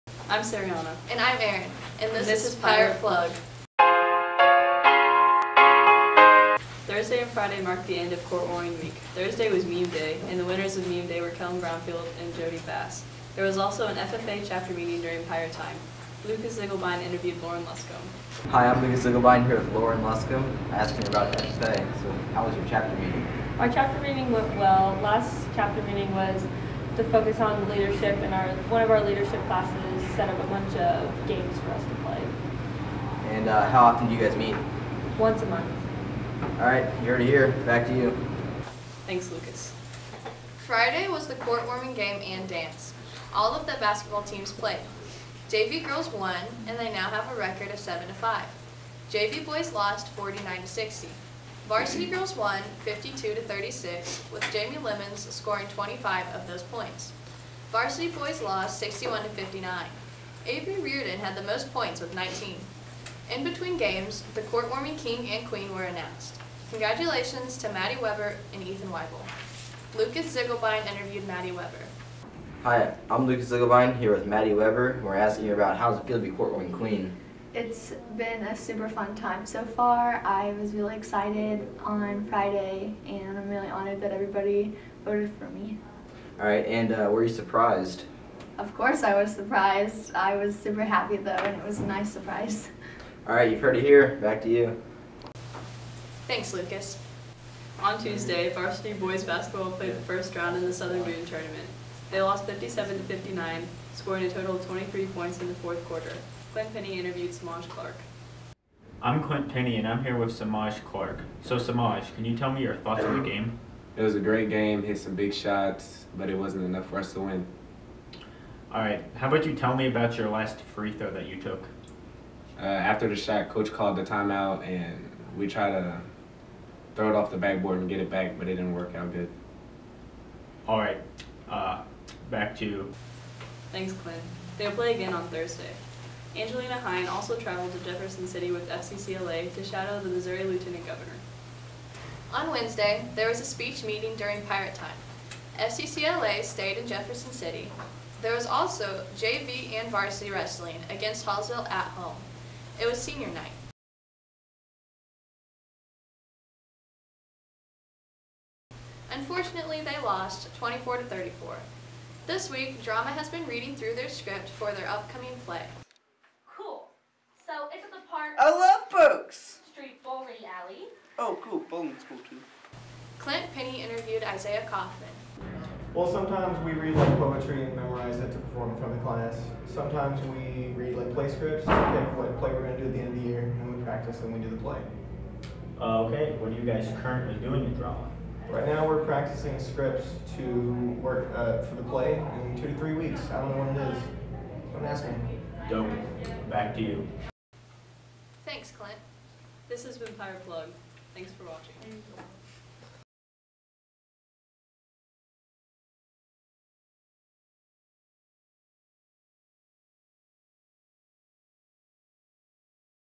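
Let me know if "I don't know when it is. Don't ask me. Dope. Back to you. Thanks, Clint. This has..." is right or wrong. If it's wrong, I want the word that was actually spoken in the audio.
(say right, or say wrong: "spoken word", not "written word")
right.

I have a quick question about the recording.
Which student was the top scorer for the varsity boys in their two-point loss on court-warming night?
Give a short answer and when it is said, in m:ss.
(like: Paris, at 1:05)
Avery Reardon, at 1:00.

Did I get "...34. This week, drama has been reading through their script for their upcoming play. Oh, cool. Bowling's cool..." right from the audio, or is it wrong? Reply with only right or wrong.
right.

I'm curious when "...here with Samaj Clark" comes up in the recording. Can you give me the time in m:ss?
1:50.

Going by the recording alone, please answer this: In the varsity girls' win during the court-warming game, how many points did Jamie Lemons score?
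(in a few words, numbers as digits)
25.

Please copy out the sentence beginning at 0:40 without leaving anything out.
Friday was the court-warming game and dance.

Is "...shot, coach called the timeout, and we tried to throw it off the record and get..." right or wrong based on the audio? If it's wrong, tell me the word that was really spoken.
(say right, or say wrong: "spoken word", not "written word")
wrong: "backboard", not "record".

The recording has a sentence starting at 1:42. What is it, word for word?
They lost 57 to 59, scoring a total of 23 points in the fourth quarter.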